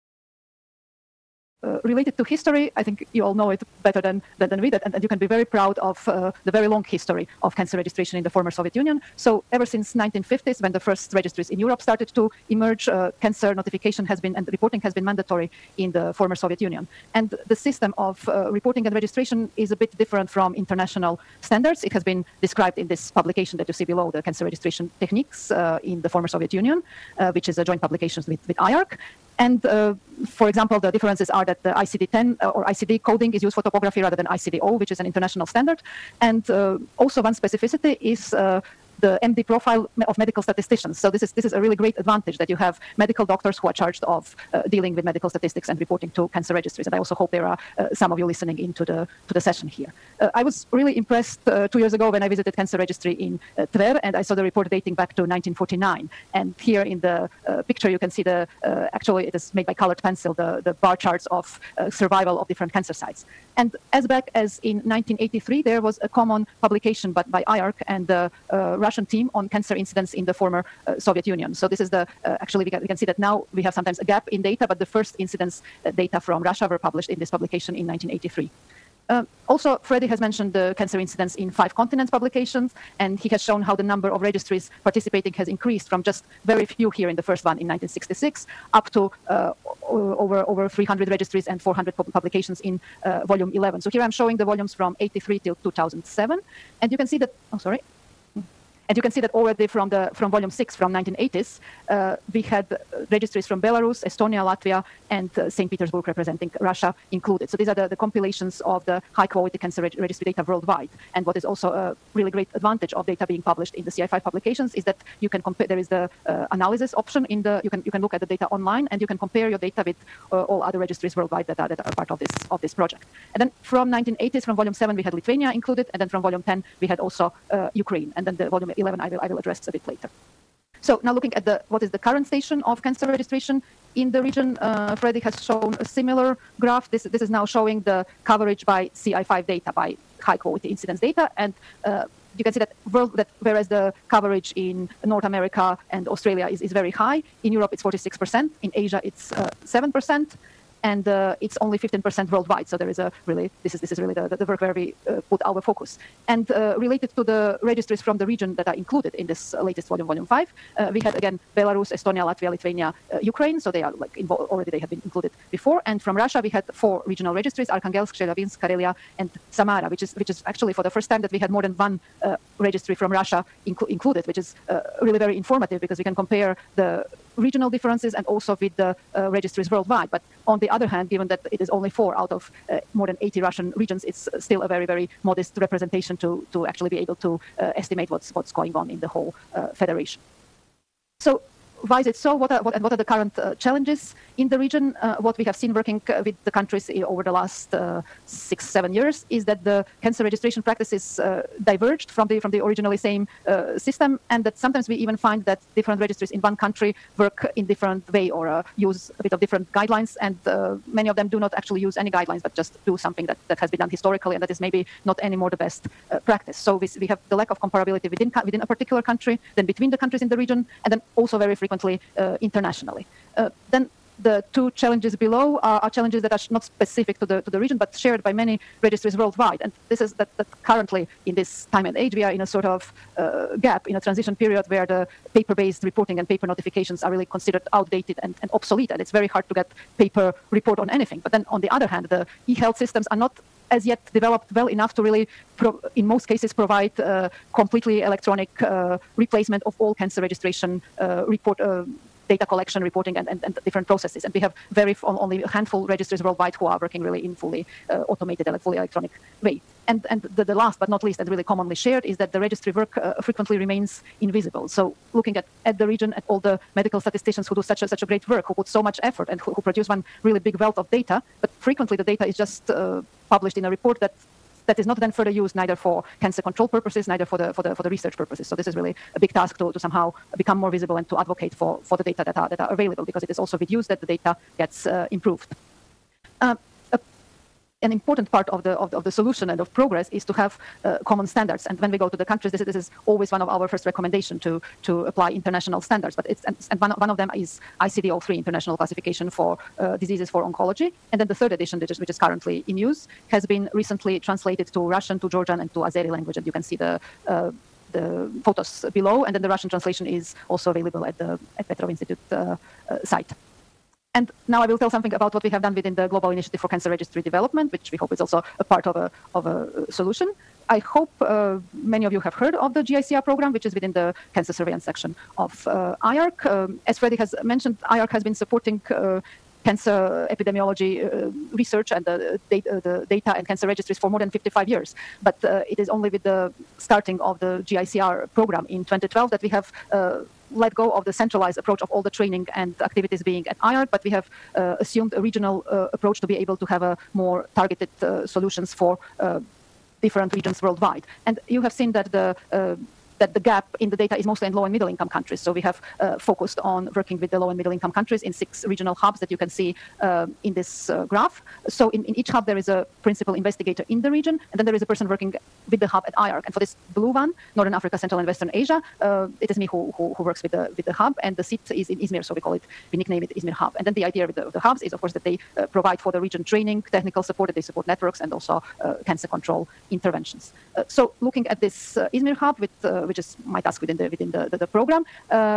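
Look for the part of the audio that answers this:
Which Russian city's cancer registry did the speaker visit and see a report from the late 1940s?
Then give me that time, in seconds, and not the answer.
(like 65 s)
53 s.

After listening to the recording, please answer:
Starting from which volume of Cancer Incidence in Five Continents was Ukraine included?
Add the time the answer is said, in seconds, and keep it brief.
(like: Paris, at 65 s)
volume 10, at 126 s.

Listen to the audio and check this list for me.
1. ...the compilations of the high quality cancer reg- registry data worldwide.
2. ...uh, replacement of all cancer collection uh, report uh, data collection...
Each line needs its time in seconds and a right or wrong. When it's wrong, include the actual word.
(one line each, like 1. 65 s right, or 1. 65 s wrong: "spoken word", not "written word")
1. 107 s right
2. 248 s wrong: "registration", not "collection".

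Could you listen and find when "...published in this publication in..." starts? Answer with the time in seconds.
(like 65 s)
76 s.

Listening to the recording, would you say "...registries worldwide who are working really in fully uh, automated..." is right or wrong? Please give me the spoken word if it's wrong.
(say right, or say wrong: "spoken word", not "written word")
right.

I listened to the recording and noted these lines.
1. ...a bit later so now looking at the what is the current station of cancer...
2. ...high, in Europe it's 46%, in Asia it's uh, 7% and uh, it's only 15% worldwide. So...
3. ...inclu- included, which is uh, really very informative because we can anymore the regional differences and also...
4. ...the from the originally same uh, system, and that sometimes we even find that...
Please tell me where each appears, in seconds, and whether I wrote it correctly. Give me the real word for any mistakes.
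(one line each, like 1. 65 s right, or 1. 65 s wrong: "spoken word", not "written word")
1. 129 s right
2. 146 s right
3. 173 s wrong: "compare", not "anymore"
4. 202 s right.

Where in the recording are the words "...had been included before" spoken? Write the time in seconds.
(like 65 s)
164 s.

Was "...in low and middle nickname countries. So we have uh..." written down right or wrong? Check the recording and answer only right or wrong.
wrong.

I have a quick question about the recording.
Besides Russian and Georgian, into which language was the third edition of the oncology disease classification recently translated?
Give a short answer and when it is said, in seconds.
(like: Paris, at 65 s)
Azeri, at 305 s.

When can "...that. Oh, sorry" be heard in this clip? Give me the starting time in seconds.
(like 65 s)
97 s.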